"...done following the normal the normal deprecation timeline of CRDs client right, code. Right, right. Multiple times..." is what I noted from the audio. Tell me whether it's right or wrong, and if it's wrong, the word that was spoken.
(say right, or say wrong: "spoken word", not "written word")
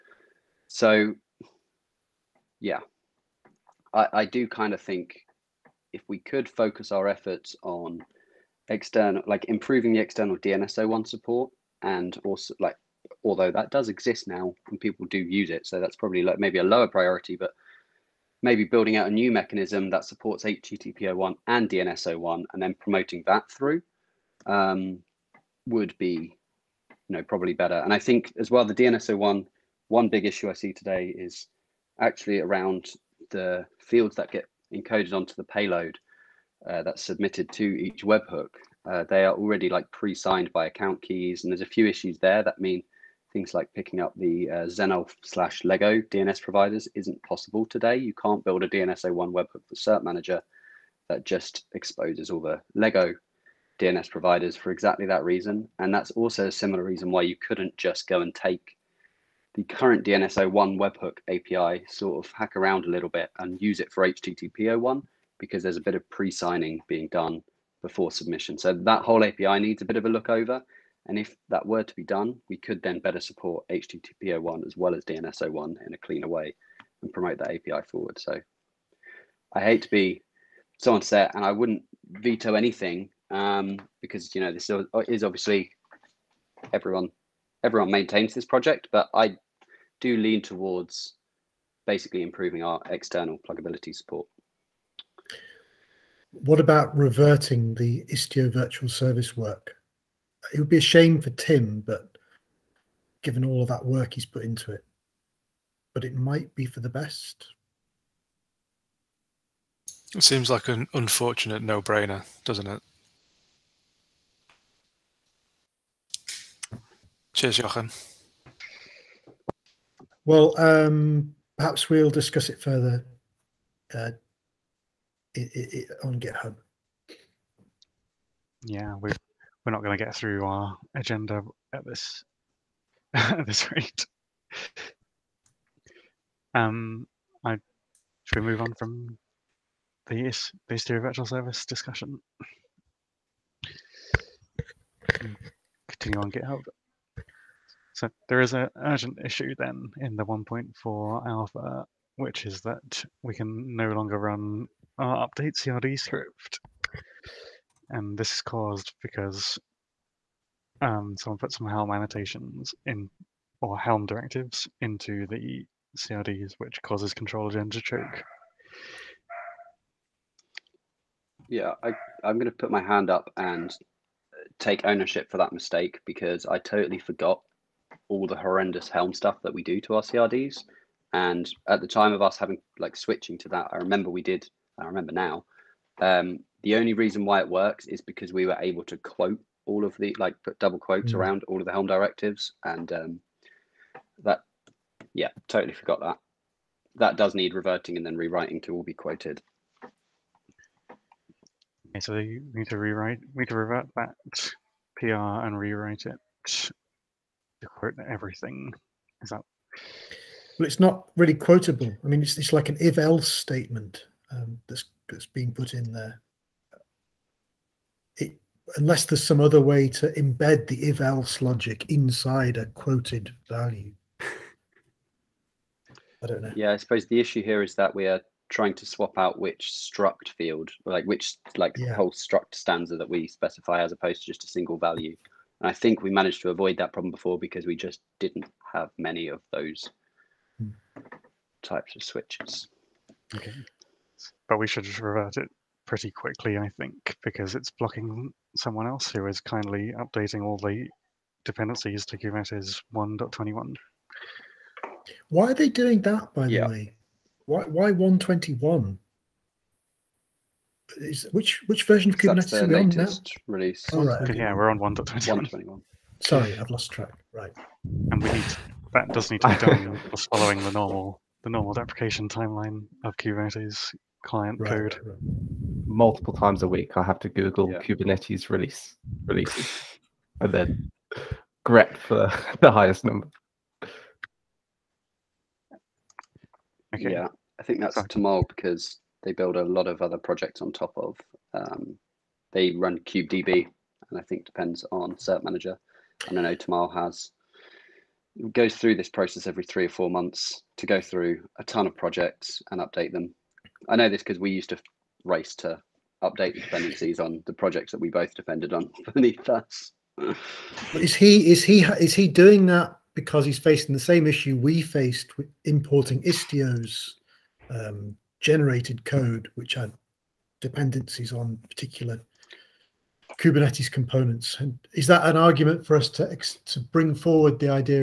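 wrong: "Kubernetes", not "CRDs".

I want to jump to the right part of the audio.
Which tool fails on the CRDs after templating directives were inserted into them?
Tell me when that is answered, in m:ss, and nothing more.
2:47.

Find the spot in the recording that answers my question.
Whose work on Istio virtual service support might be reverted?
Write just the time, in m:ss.
1:41.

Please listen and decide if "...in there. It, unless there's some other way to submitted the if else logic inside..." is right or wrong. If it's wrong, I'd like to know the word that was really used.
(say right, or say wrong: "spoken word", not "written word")
wrong: "embed", not "submitted".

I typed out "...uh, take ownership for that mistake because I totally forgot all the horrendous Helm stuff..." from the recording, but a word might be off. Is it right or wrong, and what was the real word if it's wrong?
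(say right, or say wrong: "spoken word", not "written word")
right.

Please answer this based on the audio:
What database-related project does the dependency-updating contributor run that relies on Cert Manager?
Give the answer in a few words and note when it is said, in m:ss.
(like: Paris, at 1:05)
KubeDB, at 4:52.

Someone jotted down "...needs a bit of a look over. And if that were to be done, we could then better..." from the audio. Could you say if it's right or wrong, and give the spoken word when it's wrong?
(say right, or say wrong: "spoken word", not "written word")
right.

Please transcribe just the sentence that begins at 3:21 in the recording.
Okay, so you need to rewrite, we need to revert that PR and rewrite it to quote everything.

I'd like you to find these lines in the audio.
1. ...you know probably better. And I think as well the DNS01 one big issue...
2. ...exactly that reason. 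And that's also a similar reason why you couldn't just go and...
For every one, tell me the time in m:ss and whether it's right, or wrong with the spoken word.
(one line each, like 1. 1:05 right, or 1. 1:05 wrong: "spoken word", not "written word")
1. 0:27 right
2. 0:54 right.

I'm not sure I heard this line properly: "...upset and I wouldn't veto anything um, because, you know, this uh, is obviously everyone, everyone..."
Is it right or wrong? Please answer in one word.
right.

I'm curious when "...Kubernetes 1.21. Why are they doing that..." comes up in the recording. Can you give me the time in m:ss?
4:12.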